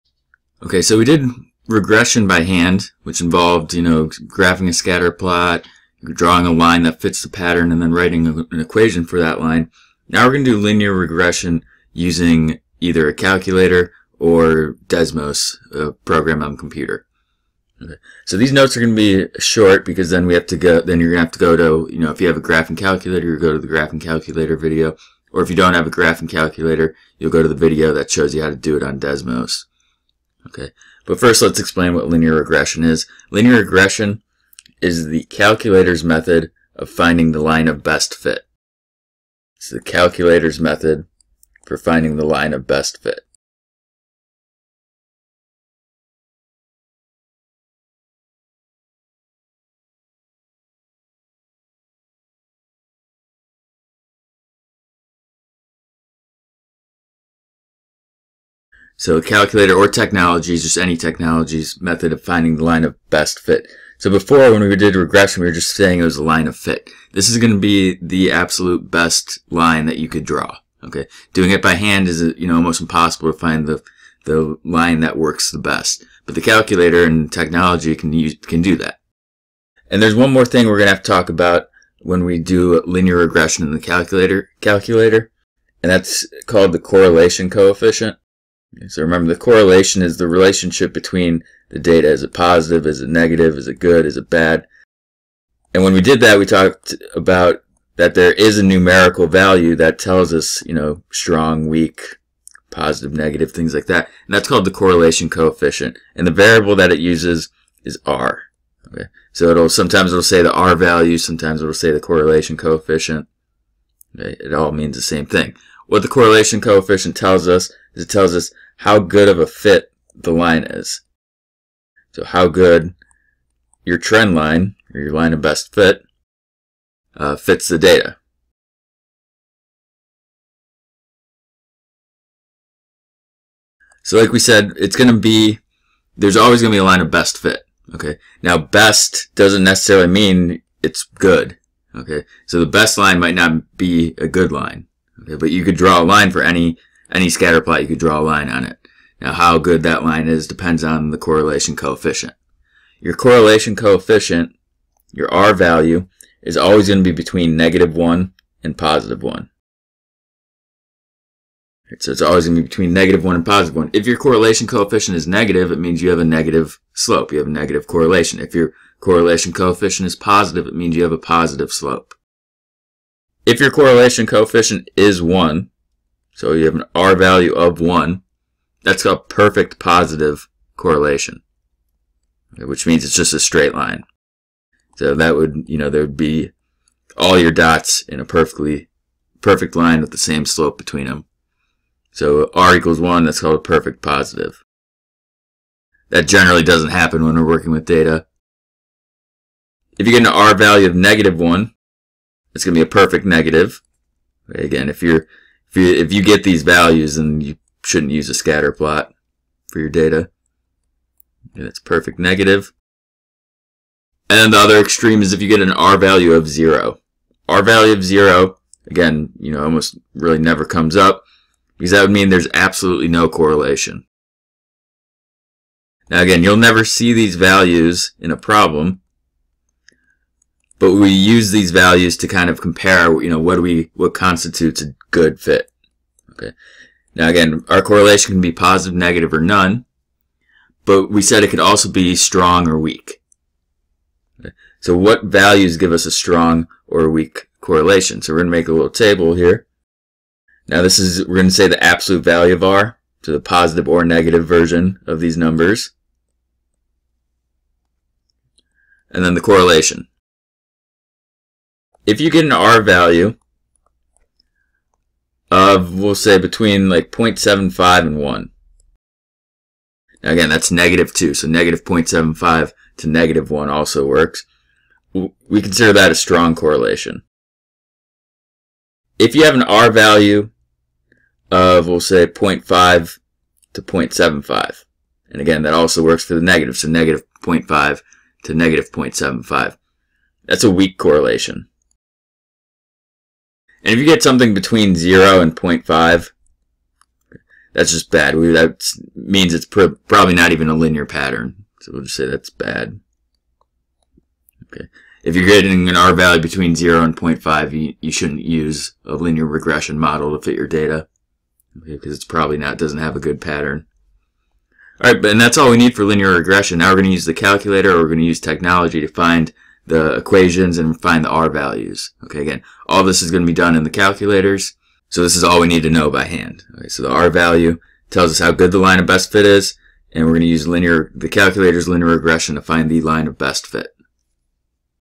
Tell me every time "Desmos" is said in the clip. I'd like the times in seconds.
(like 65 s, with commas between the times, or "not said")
14 s, 28 s.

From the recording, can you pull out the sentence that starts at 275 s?
We consider that a strong correlation.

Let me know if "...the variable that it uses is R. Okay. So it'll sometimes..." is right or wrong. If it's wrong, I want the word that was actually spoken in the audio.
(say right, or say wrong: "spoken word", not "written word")
right.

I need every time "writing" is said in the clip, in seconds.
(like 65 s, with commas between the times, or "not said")
7 s.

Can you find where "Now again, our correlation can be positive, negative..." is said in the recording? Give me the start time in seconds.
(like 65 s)
237 s.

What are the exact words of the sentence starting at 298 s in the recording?
that means it's pr probably not even a linear pattern.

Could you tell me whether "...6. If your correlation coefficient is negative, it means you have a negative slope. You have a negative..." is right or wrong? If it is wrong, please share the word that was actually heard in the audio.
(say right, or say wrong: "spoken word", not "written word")
wrong: "1", not "6".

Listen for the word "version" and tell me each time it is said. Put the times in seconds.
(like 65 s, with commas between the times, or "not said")
254 s.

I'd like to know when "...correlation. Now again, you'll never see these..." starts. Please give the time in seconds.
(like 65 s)
223 s.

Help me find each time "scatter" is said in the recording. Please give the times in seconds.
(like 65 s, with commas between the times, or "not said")
4 s, 147 s, 208 s.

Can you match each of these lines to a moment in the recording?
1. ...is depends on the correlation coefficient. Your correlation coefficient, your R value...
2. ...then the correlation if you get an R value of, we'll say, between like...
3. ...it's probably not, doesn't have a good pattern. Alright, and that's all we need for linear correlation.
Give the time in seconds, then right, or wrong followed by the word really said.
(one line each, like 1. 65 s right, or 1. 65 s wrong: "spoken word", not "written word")
1. 150 s right
2. 259 s right
3. 312 s wrong: "regression", not "correlation".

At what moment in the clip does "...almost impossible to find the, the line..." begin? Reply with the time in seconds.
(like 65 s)
72 s.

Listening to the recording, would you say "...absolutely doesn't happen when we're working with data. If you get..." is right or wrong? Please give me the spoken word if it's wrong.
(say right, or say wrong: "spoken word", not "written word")
wrong: "generally", not "absolutely".